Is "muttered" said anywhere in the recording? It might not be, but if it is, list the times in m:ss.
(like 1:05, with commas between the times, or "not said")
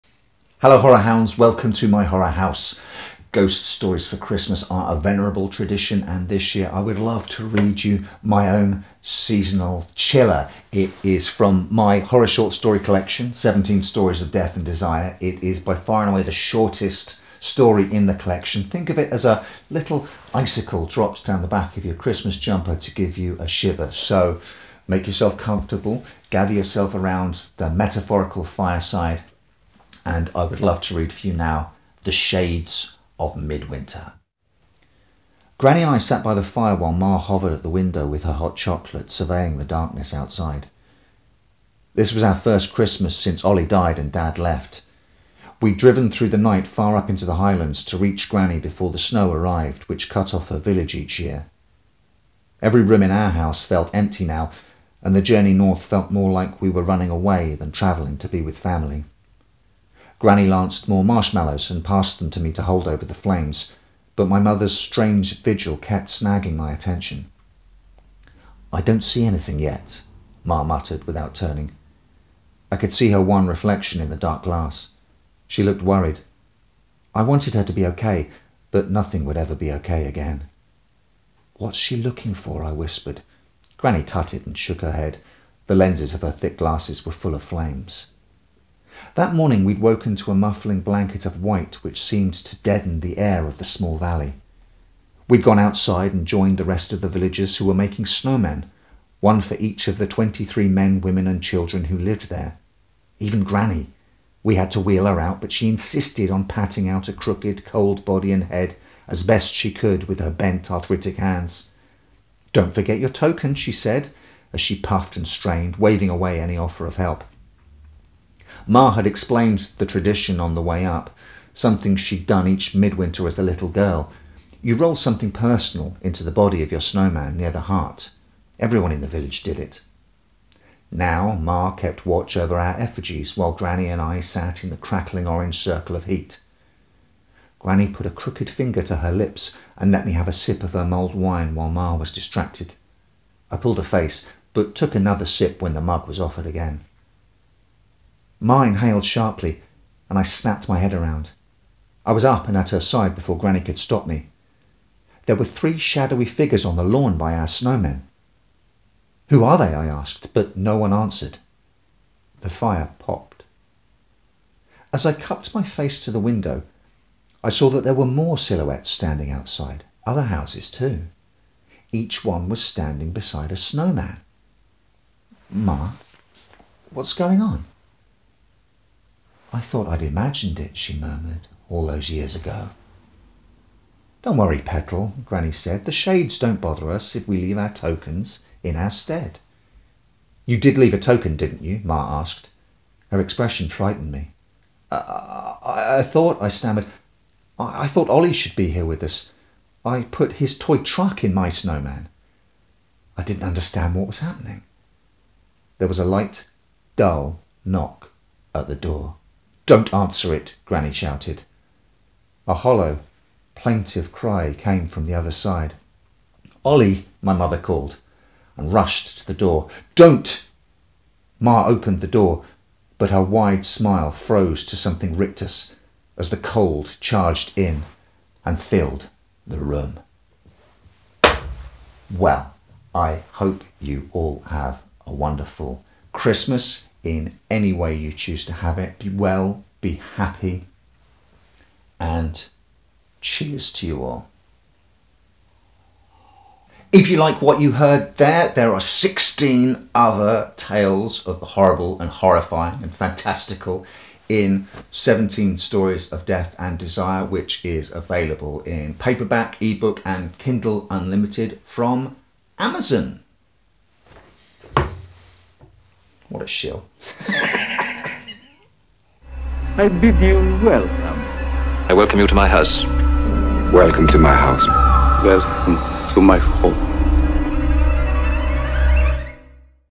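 1:10.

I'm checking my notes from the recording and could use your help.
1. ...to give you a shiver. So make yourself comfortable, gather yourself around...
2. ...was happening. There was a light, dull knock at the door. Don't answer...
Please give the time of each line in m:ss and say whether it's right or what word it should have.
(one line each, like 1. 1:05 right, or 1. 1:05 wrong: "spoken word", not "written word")
1. 0:22 right
2. 3:24 right.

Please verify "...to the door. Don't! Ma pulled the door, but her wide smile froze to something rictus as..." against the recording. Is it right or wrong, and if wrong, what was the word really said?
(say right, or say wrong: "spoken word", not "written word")
wrong: "opened", not "pulled".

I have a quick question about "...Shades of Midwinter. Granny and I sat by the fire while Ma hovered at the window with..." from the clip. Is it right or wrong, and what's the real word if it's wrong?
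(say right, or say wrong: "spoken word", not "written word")
right.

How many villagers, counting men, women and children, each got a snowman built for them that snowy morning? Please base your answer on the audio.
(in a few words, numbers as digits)
23.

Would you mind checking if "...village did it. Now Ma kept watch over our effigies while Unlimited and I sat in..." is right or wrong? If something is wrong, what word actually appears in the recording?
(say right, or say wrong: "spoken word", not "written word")
wrong: "Granny", not "Unlimited".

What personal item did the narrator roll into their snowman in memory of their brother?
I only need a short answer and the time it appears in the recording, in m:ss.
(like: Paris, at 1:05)
Toy truck, at 3:20.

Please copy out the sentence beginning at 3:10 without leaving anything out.
You did leave a token, didn't you?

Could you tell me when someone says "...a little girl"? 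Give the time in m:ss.
2:03.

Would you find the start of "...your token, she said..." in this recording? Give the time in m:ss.
1:52.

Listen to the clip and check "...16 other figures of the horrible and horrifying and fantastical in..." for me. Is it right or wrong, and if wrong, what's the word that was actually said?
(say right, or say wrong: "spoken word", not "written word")
wrong: "tales", not "figures".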